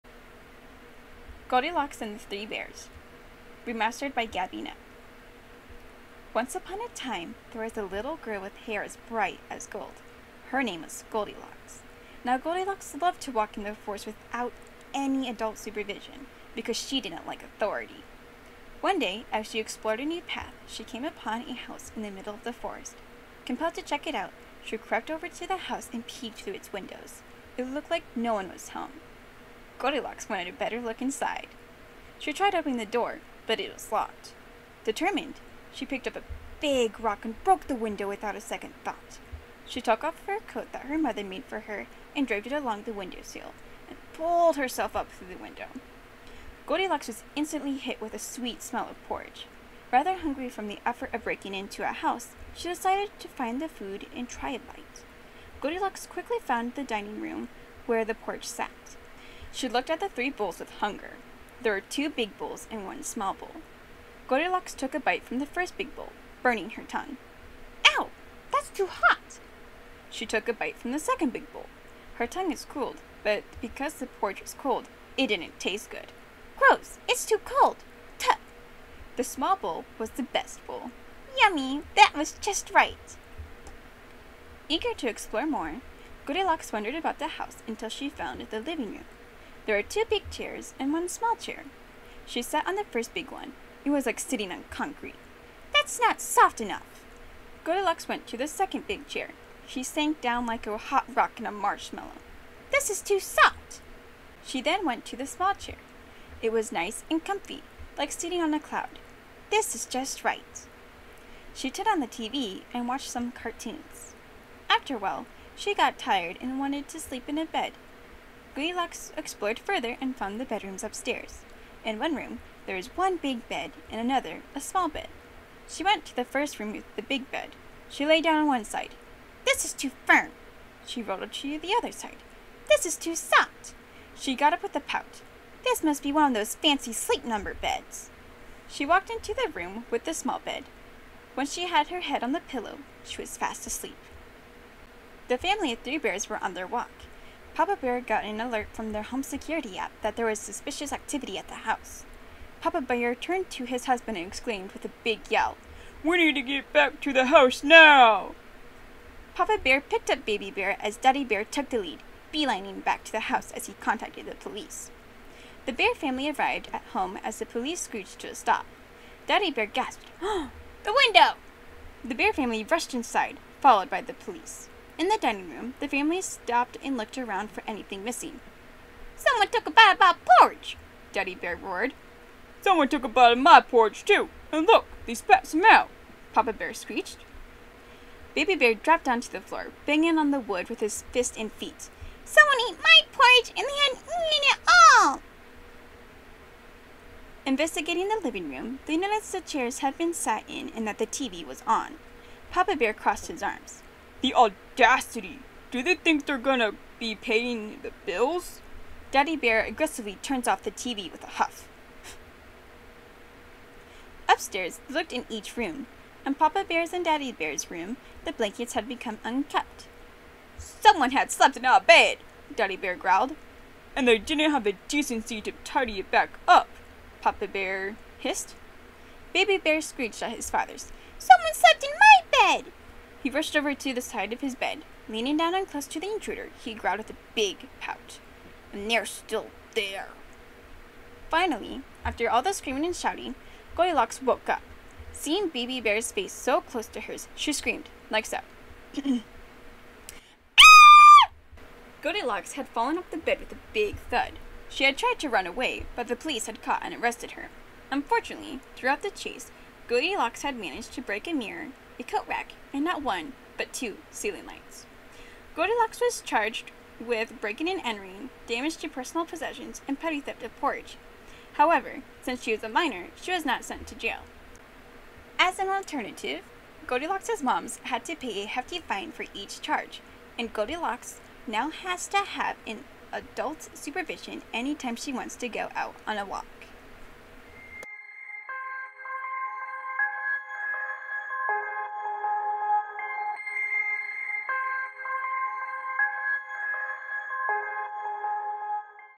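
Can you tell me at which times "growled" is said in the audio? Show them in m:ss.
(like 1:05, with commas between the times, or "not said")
3:42, 3:56.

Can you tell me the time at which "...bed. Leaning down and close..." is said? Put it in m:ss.
3:54.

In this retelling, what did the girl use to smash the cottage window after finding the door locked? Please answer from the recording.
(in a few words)
a big rock.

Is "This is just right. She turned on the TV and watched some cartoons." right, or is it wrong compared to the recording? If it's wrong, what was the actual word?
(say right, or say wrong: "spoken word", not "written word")
right.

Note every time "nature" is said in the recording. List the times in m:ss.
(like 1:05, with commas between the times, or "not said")
not said.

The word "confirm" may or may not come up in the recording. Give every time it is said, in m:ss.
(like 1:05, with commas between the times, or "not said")
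not said.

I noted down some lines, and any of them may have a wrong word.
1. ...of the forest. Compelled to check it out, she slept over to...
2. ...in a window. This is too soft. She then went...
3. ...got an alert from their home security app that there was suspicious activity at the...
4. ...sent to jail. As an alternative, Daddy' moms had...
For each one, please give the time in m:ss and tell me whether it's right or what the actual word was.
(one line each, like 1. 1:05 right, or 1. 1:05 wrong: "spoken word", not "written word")
1. 0:22 wrong: "crept", not "slept"
2. 1:41 wrong: "marshmallow", not "window"
3. 2:28 right
4. 4:33 wrong: "Goldilocks", not "Daddy".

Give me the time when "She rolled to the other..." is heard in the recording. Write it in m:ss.
2:10.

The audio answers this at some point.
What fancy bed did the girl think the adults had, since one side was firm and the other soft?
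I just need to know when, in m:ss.
2:16.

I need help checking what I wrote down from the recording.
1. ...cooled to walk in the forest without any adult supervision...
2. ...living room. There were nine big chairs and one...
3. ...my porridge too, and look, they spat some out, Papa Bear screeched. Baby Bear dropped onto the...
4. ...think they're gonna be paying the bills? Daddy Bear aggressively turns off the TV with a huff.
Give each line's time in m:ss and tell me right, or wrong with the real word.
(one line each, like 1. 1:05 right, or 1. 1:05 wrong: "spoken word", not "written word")
1. 0:13 wrong: "loved", not "cooled"
2. 1:28 wrong: "two", not "nine"
3. 3:03 right
4. 3:25 right.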